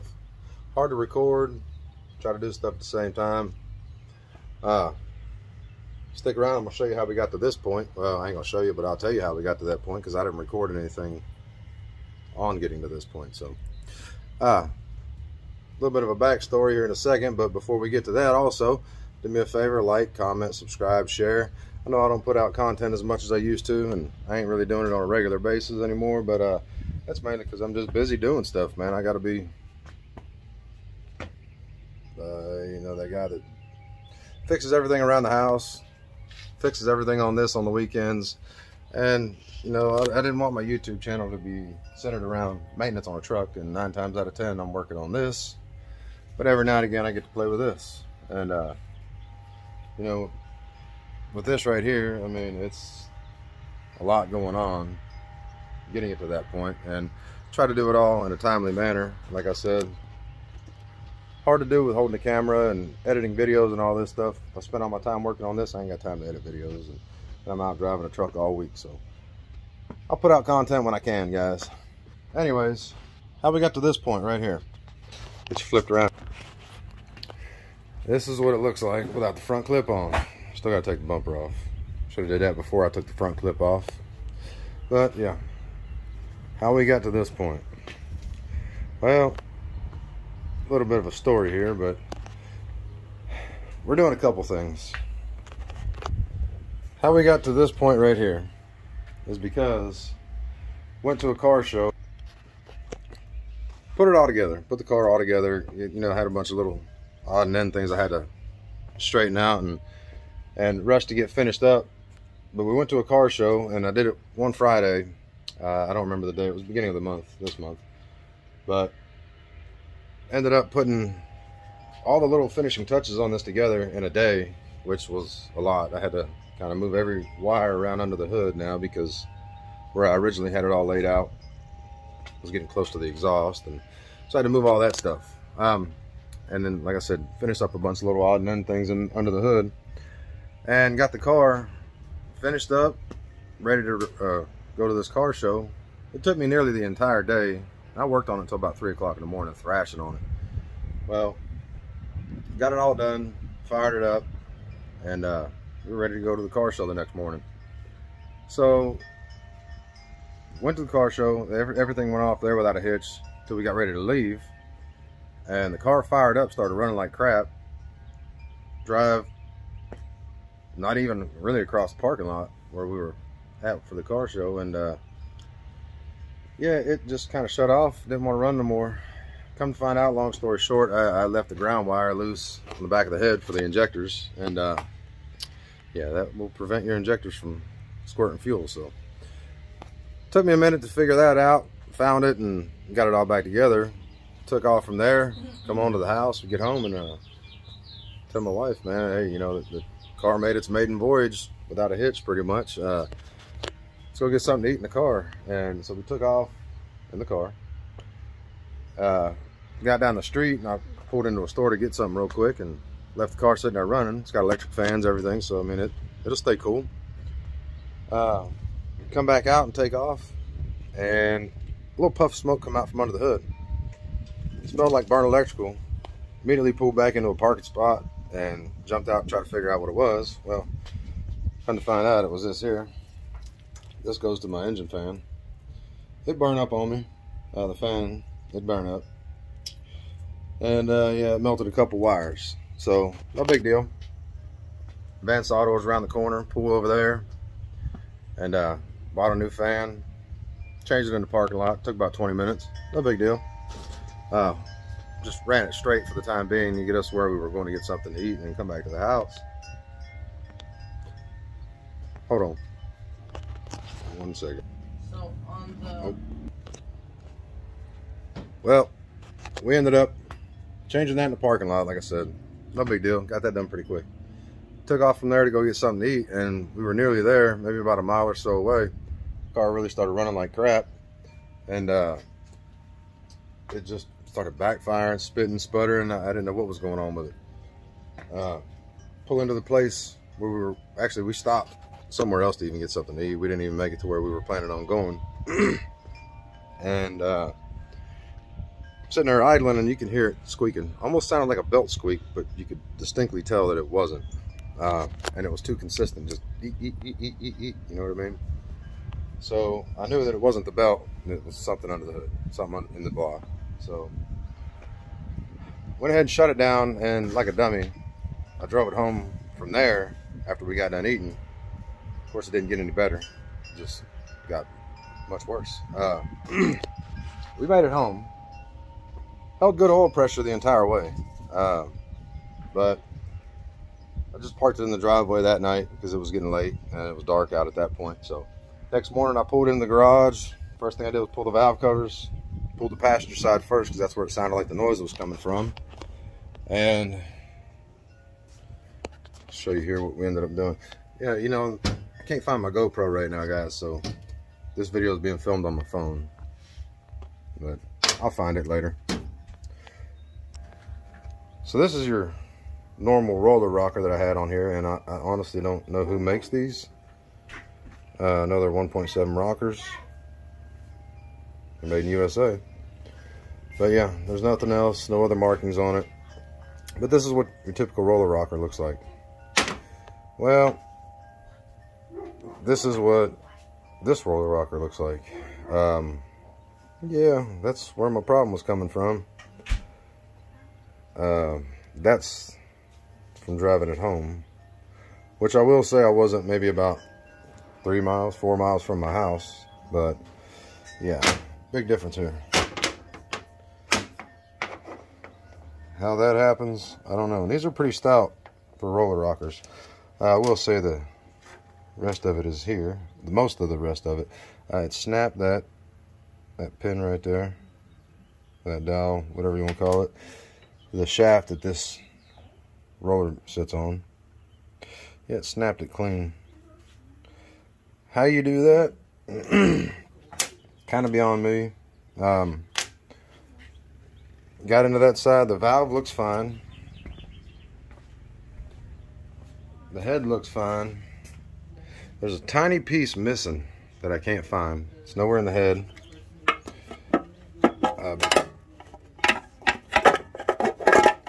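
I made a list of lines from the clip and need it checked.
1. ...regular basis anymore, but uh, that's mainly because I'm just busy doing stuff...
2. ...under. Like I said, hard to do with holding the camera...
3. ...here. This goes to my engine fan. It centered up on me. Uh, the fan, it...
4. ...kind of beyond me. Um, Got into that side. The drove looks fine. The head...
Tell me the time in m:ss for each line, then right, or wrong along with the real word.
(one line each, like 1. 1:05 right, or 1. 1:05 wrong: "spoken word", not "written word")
1. 0:25 right
2. 0:58 wrong: "manner", not "under"
3. 3:52 wrong: "burned", not "centered"
4. 7:10 wrong: "valve", not "drove".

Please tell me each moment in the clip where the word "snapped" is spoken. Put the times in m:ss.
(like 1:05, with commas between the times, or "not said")
6:54, 7:05.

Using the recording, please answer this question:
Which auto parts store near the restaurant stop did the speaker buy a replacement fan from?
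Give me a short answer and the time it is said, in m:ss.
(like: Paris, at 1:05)
Vance Auto, at 4:05.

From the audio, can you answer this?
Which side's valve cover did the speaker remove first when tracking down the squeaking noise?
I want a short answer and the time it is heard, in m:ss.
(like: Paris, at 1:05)
passenger side, at 5:42.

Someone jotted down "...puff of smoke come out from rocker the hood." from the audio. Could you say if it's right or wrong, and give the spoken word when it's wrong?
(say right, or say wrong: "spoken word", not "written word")
wrong: "under", not "rocker".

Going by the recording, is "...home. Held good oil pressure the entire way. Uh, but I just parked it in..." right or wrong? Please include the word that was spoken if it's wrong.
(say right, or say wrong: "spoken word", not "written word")
right.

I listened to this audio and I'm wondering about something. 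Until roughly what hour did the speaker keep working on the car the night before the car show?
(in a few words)
3 o'clock in the morning.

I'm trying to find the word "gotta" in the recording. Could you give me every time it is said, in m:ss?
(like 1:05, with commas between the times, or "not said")
1:20.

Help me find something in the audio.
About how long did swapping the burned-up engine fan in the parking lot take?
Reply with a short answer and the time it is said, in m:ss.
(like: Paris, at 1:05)
20 minutes, at 4:12.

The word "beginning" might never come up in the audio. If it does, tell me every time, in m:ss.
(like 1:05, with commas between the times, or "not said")
1:56.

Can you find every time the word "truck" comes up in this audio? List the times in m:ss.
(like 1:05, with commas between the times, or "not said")
0:43, 1:08.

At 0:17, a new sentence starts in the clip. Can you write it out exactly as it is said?
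But before we get to that also, do me a favor.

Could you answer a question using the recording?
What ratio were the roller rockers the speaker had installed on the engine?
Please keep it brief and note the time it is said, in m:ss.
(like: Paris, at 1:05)
1.7, at 6:08.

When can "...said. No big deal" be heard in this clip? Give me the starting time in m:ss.
4:32.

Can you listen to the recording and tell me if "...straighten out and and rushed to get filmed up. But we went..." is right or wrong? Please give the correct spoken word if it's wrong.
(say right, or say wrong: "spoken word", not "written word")
wrong: "finished", not "filmed".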